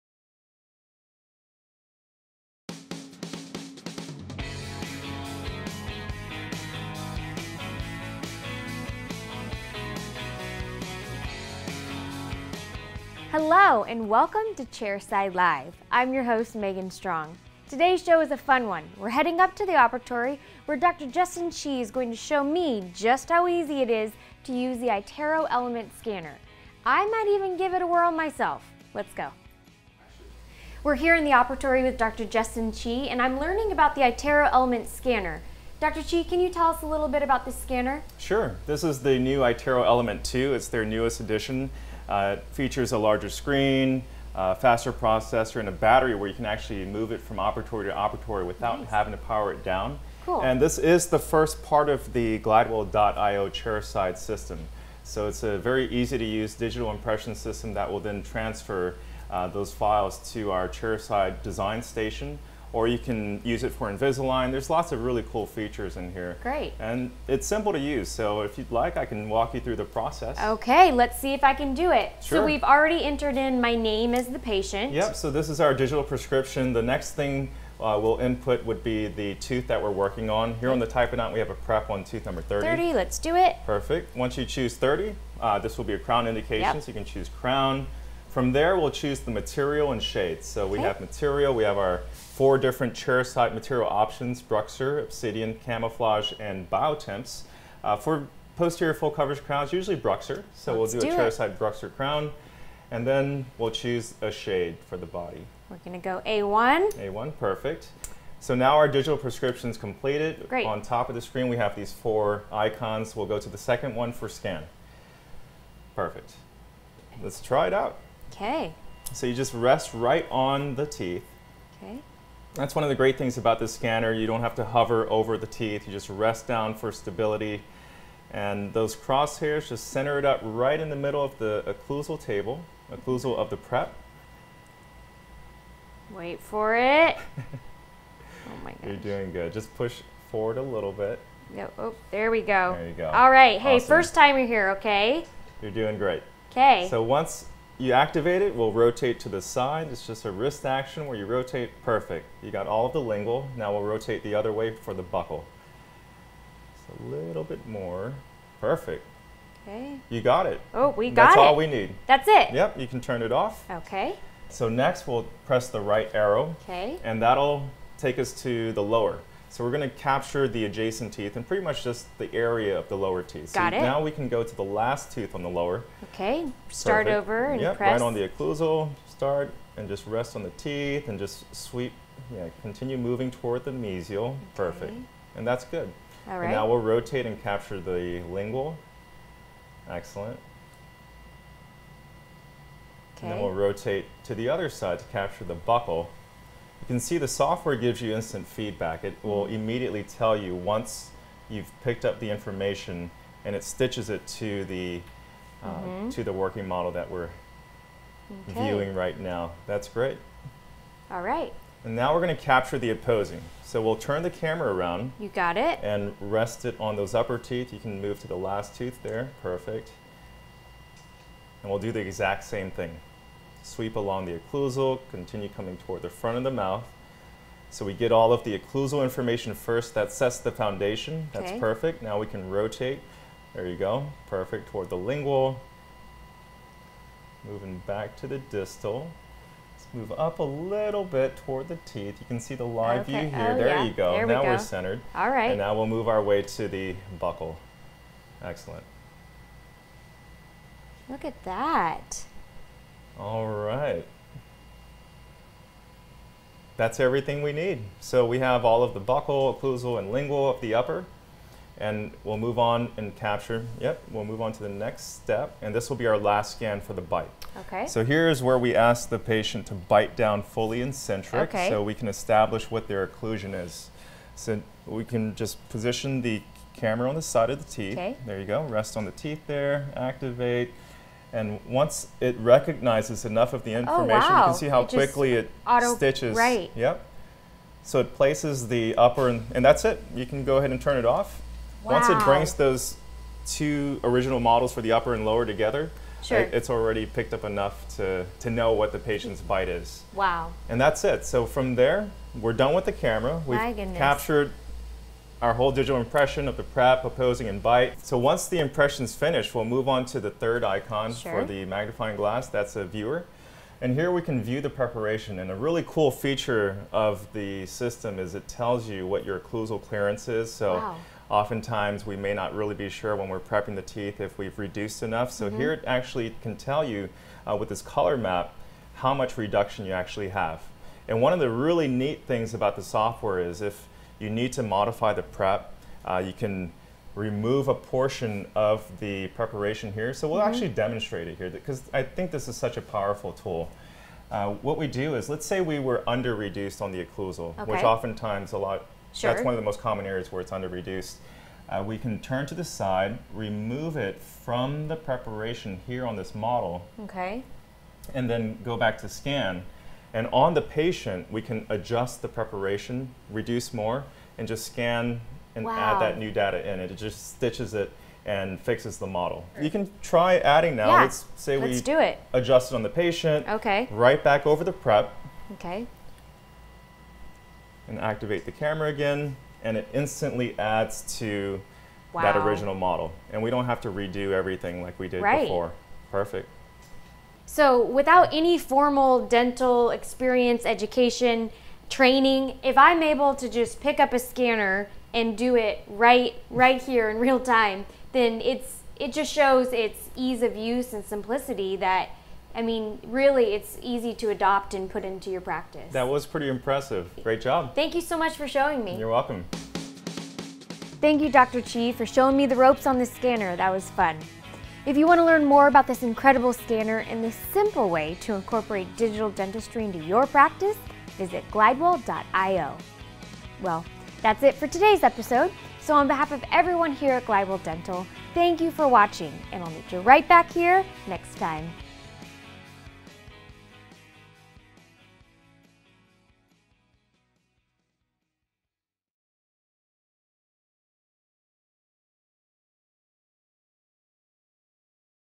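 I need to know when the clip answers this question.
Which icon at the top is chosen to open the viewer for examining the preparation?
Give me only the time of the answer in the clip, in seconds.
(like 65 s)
311 s.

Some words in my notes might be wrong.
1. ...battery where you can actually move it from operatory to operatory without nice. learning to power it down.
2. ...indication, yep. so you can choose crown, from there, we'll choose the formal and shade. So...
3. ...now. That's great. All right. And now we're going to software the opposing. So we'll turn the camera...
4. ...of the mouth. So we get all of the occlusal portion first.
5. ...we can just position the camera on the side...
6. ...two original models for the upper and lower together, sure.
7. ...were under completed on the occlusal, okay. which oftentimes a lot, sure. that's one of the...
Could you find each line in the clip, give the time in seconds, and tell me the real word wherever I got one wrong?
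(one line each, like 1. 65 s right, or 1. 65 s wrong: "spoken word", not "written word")
1. 45 s wrong: "having", not "learning"
2. 86 s wrong: "material", not "formal"
3. 209 s wrong: "capture", not "software"
4. 226 s wrong: "information", not "portion"
5. 274 s right
6. 293 s right
7. 345 s wrong: "reduced", not "completed".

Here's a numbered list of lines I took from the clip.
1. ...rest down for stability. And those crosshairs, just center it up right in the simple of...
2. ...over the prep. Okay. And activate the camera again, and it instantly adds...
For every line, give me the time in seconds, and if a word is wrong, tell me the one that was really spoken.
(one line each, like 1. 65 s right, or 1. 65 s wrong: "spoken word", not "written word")
1. 126 s wrong: "middle", not "simple"
2. 374 s right.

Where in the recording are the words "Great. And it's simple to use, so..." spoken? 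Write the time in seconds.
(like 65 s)
66 s.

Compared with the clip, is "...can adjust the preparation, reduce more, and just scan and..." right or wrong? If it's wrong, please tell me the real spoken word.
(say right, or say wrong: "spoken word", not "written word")
right.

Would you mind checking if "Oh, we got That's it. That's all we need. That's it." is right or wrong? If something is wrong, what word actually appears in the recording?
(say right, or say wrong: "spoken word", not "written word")
right.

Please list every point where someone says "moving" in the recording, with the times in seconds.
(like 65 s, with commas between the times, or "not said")
182 s, 237 s.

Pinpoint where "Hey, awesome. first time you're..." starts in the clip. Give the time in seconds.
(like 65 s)
143 s.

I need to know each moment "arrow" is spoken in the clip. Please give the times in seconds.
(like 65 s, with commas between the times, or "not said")
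166 s.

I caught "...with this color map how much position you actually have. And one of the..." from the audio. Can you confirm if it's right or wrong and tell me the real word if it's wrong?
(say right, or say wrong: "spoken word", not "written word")
wrong: "reduction", not "position".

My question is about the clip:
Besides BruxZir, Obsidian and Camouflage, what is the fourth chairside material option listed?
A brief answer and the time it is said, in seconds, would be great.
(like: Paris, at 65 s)
Biotemps, at 96 s.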